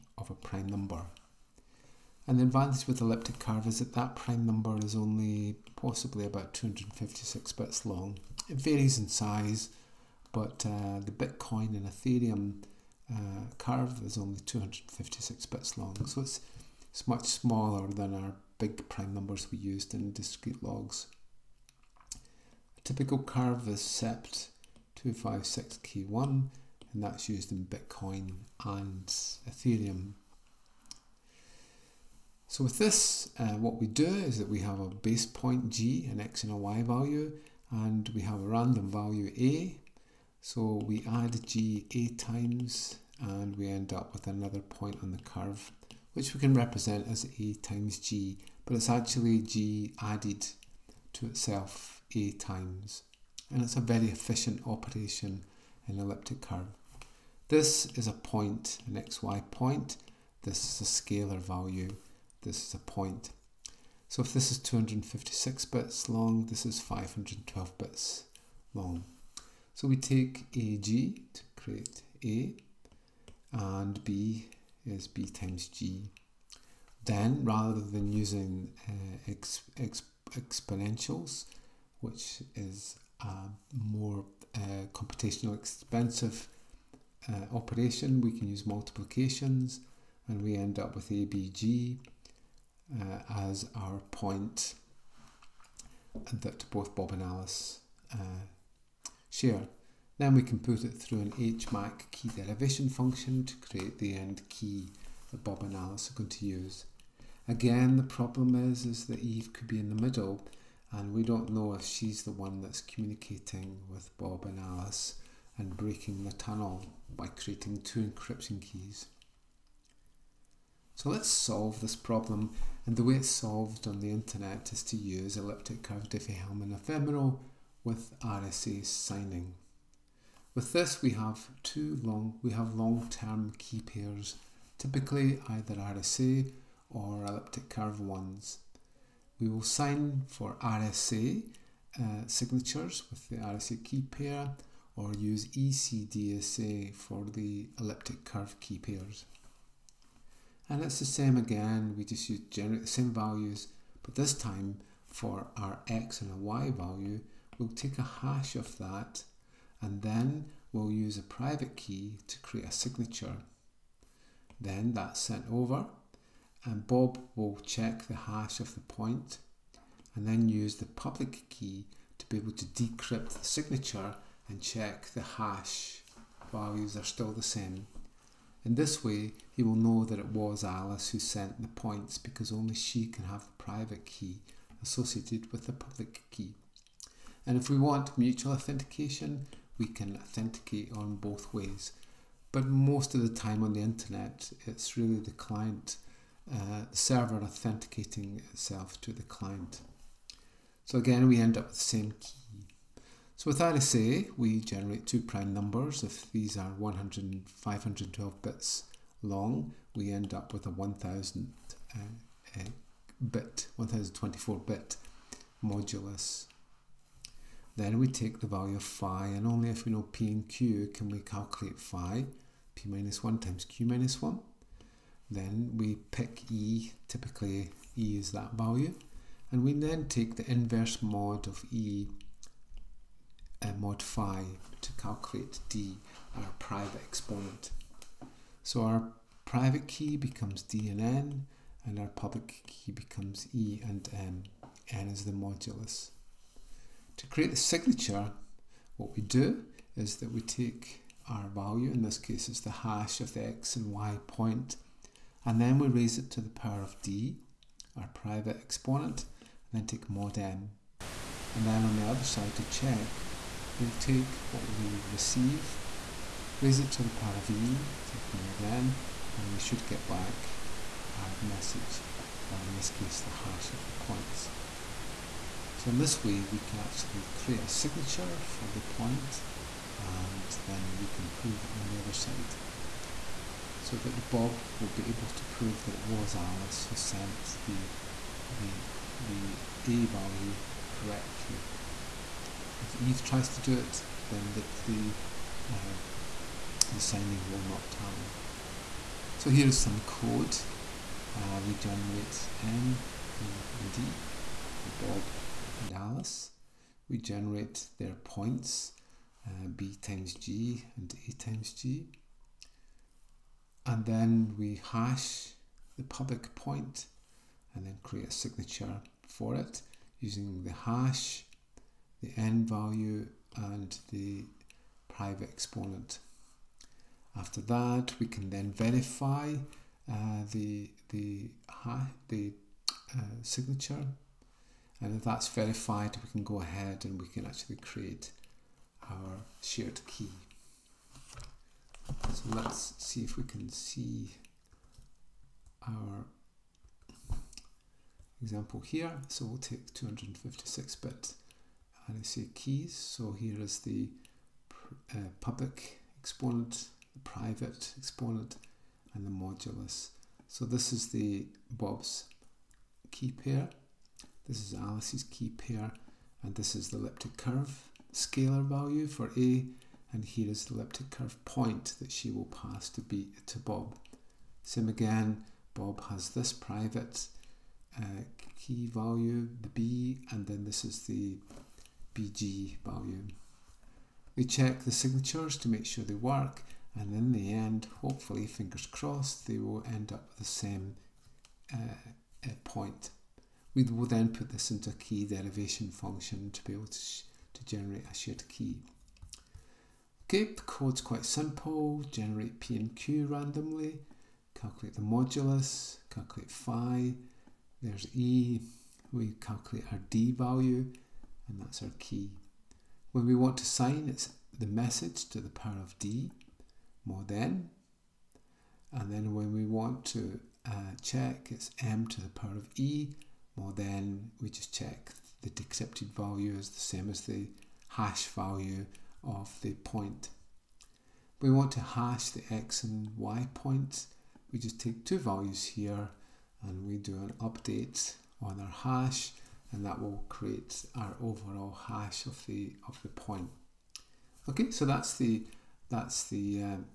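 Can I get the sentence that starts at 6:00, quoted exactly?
So this is the Bob's key pair.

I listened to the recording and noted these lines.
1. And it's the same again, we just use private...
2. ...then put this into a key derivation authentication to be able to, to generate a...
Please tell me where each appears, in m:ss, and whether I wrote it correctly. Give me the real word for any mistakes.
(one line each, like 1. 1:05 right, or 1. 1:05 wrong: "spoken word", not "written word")
1. 2:30 wrong: "generate", not "private"
2. 6:34 wrong: "function", not "authentication".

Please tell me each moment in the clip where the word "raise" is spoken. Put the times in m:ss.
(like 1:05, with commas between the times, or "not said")
4:15, 4:26.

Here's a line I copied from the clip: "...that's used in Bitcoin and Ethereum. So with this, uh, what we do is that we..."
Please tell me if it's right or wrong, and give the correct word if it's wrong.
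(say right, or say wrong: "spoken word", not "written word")
right.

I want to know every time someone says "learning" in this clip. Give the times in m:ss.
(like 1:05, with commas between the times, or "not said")
not said.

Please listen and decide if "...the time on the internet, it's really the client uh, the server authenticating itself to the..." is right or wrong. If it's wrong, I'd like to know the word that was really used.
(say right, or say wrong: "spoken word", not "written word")
right.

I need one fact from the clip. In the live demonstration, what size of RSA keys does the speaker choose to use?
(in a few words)
256 bit.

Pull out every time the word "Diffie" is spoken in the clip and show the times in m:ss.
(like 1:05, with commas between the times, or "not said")
2:06.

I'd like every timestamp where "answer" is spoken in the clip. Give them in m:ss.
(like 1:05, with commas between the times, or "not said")
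not said.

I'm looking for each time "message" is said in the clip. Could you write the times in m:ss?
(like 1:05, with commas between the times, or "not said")
4:31, 6:54.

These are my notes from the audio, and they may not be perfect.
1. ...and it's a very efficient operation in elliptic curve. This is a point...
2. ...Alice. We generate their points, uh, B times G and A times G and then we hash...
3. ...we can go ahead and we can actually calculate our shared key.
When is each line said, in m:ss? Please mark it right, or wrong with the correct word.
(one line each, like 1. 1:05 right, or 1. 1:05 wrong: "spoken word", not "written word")
1. 0:53 right
2. 5:05 right
3. 5:36 wrong: "create", not "calculate".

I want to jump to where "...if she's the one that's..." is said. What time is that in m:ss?
1:51.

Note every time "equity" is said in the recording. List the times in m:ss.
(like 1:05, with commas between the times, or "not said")
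not said.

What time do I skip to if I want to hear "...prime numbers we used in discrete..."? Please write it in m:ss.
0:18.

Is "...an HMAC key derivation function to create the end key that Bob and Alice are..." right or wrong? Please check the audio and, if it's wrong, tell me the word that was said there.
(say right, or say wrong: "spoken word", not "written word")
right.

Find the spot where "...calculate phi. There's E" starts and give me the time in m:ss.
6:46.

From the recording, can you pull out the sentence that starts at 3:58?
So our private key becomes d and n, and our public key becomes e and n.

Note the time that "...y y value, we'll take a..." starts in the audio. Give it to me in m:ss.
2:36.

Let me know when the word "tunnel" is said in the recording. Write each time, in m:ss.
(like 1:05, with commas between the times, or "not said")
1:56.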